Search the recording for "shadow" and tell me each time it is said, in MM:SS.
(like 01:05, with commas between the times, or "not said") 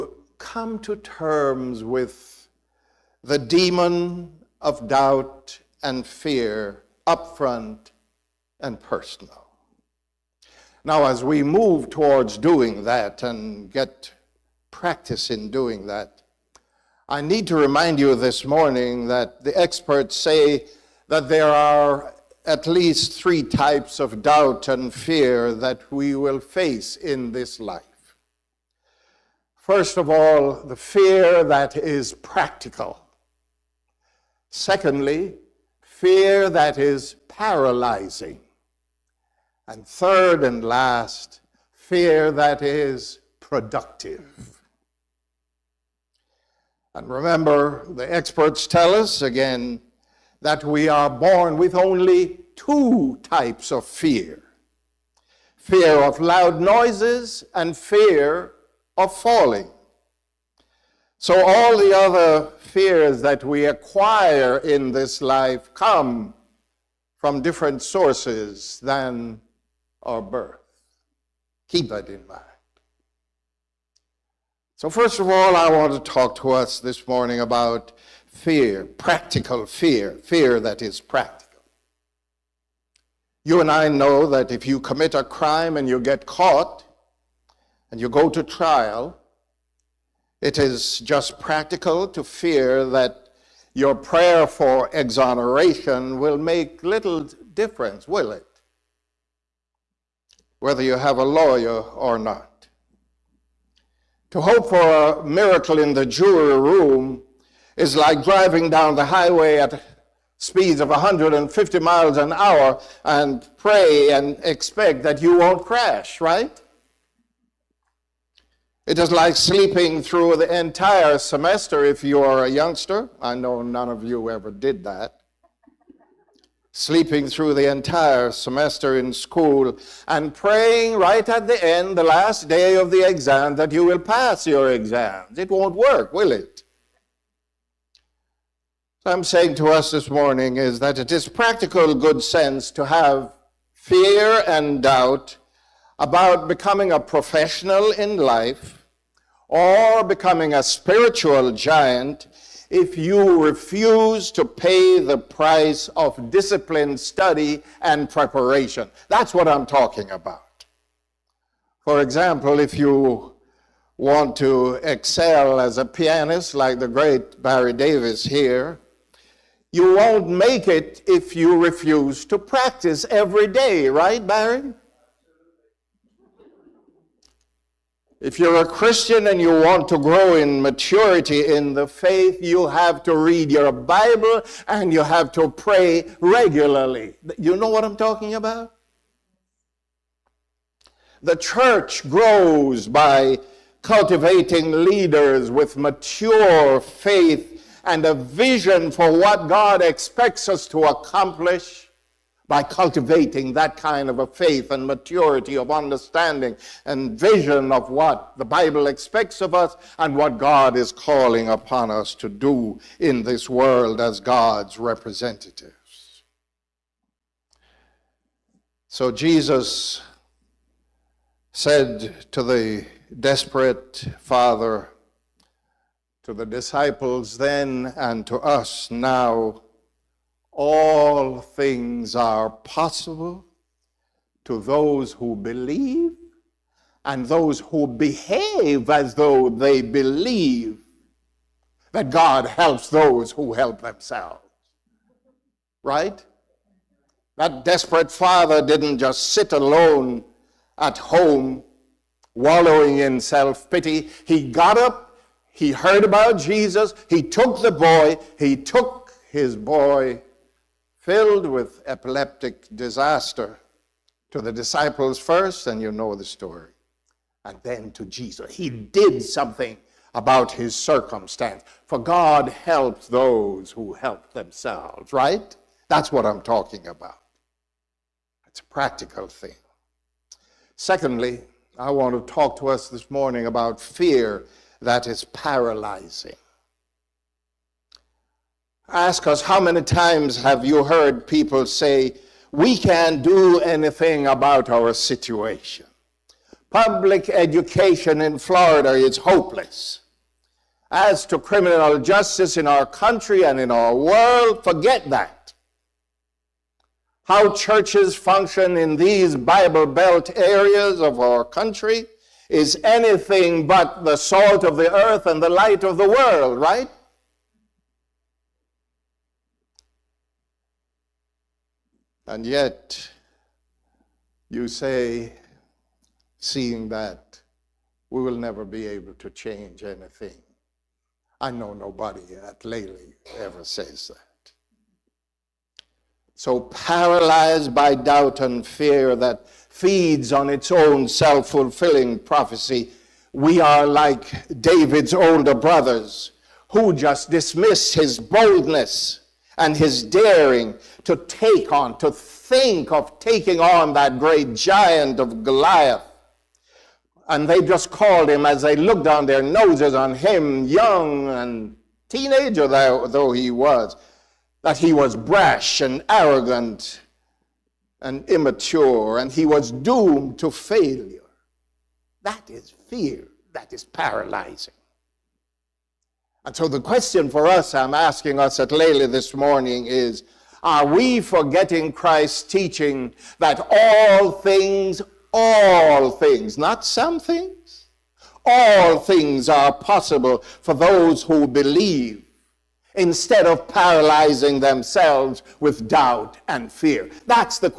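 not said.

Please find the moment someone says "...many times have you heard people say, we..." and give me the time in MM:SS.
04:49.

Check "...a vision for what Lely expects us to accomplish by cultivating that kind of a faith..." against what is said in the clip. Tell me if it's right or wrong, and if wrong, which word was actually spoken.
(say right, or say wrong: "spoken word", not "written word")
wrong: "God", not "Lely".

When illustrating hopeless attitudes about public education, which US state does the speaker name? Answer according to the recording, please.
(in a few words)
Florida.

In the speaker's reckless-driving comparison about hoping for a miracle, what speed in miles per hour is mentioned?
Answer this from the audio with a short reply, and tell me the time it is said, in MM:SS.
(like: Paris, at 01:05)
150, at 01:50.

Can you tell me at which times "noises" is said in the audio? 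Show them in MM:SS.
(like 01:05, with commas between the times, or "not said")
00:56.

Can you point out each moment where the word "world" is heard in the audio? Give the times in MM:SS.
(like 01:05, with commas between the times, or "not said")
03:33, 05:03, 05:16.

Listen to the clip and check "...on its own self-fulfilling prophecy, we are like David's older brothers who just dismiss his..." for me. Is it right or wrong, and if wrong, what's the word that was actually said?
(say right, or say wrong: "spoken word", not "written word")
right.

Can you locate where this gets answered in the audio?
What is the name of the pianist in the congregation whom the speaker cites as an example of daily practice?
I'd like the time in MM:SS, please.
02:47.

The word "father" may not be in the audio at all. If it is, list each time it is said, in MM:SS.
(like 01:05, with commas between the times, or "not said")
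03:44, 04:08.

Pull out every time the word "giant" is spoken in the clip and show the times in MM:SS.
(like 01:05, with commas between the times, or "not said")
02:31, 05:54.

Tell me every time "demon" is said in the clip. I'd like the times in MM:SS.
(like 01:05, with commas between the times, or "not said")
00:03.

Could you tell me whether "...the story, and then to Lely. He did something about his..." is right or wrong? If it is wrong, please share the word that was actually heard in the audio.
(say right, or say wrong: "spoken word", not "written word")
wrong: "Jesus", not "Lely".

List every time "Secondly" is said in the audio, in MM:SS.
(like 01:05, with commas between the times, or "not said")
00:34, 04:40.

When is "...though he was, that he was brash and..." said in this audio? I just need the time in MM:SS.
06:02.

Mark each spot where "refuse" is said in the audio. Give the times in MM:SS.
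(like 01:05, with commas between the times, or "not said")
02:33, 02:51.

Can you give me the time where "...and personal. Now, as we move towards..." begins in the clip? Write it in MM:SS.
00:08.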